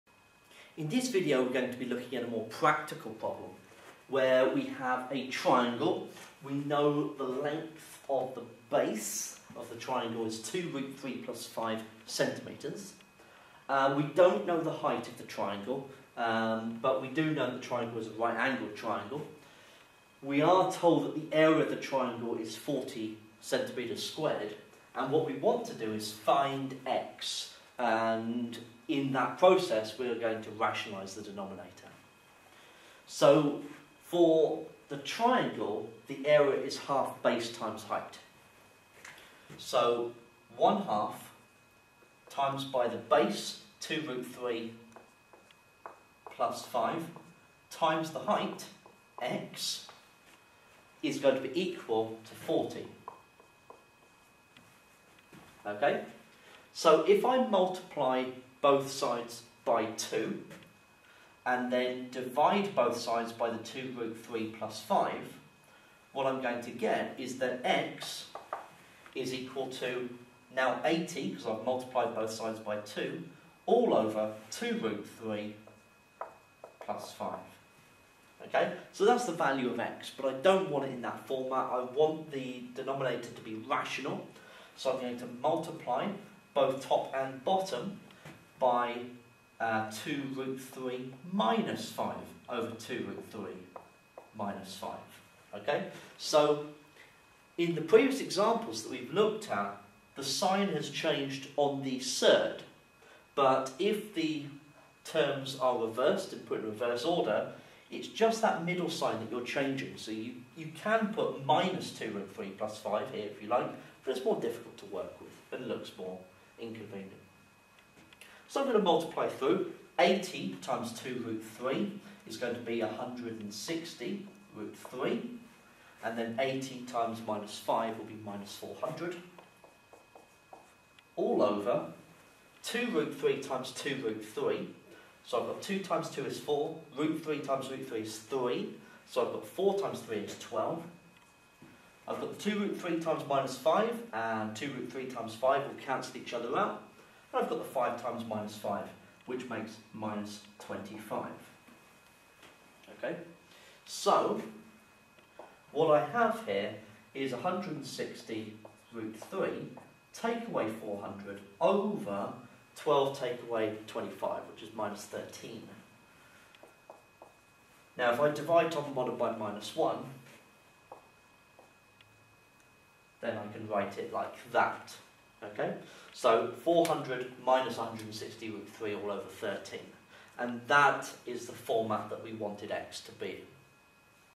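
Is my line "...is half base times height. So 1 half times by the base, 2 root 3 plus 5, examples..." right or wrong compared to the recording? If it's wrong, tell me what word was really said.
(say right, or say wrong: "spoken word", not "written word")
wrong: "times", not "examples".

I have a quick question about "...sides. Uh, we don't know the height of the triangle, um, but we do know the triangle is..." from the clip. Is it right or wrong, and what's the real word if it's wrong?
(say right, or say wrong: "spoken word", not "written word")
wrong: "centimetres", not "sides".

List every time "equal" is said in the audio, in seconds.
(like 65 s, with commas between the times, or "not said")
51 s, 69 s.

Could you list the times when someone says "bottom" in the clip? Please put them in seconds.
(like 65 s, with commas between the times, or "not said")
87 s, 168 s.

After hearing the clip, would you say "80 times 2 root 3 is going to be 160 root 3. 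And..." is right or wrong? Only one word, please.
right.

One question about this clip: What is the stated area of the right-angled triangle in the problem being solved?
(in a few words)
40 square centimetres.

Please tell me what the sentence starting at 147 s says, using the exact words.
And I've got the 5 times minus 5, which makes minus 25.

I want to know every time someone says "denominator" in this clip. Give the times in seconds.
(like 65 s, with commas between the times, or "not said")
31 s, 82 s.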